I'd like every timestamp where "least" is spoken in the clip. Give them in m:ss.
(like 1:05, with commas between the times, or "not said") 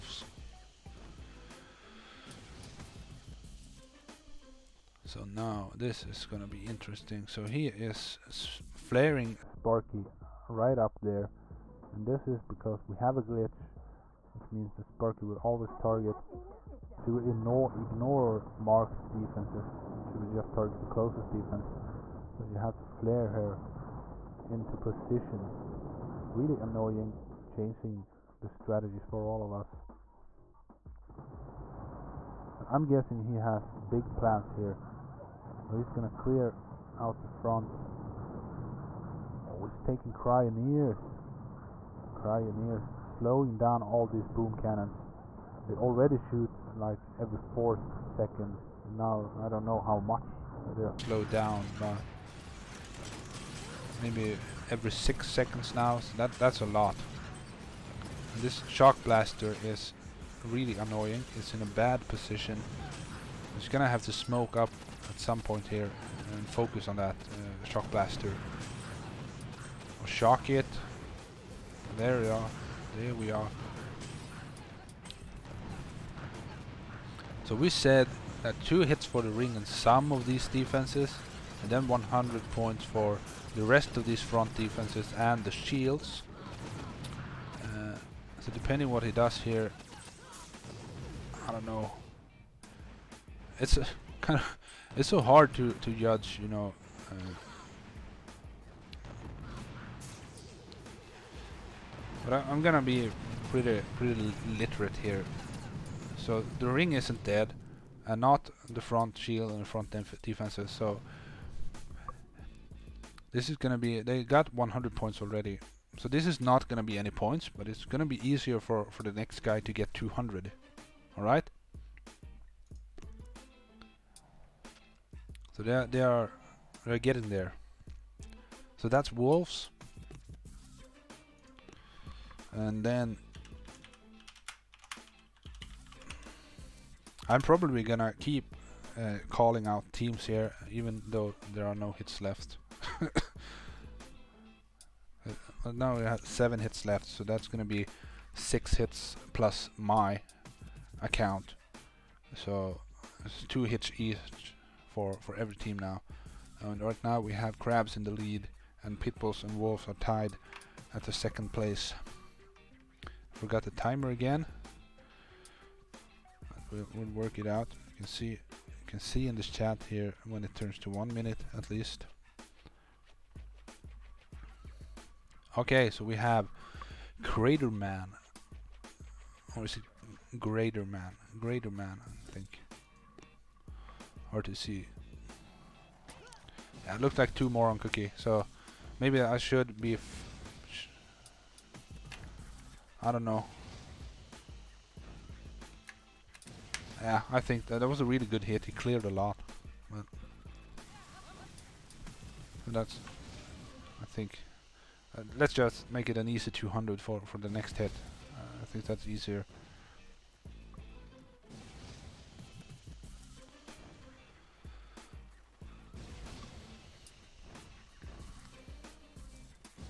2:51.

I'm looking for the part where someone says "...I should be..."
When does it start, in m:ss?
3:09.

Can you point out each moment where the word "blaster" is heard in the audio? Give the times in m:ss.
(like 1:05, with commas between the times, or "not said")
0:59, 1:07.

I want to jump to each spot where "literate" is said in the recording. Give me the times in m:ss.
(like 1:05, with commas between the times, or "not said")
1:44.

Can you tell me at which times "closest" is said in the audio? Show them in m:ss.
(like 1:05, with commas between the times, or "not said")
0:20.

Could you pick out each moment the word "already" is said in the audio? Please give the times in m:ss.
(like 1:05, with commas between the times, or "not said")
0:45, 1:55.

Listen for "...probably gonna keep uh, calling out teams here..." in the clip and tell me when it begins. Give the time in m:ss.
2:17.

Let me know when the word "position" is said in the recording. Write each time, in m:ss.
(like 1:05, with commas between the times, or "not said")
0:24, 1:02.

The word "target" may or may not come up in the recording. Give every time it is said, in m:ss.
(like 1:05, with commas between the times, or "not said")
0:15, 0:20.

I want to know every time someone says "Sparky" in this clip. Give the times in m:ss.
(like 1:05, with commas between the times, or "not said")
0:09, 0:14.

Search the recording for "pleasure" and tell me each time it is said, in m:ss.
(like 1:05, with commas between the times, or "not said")
not said.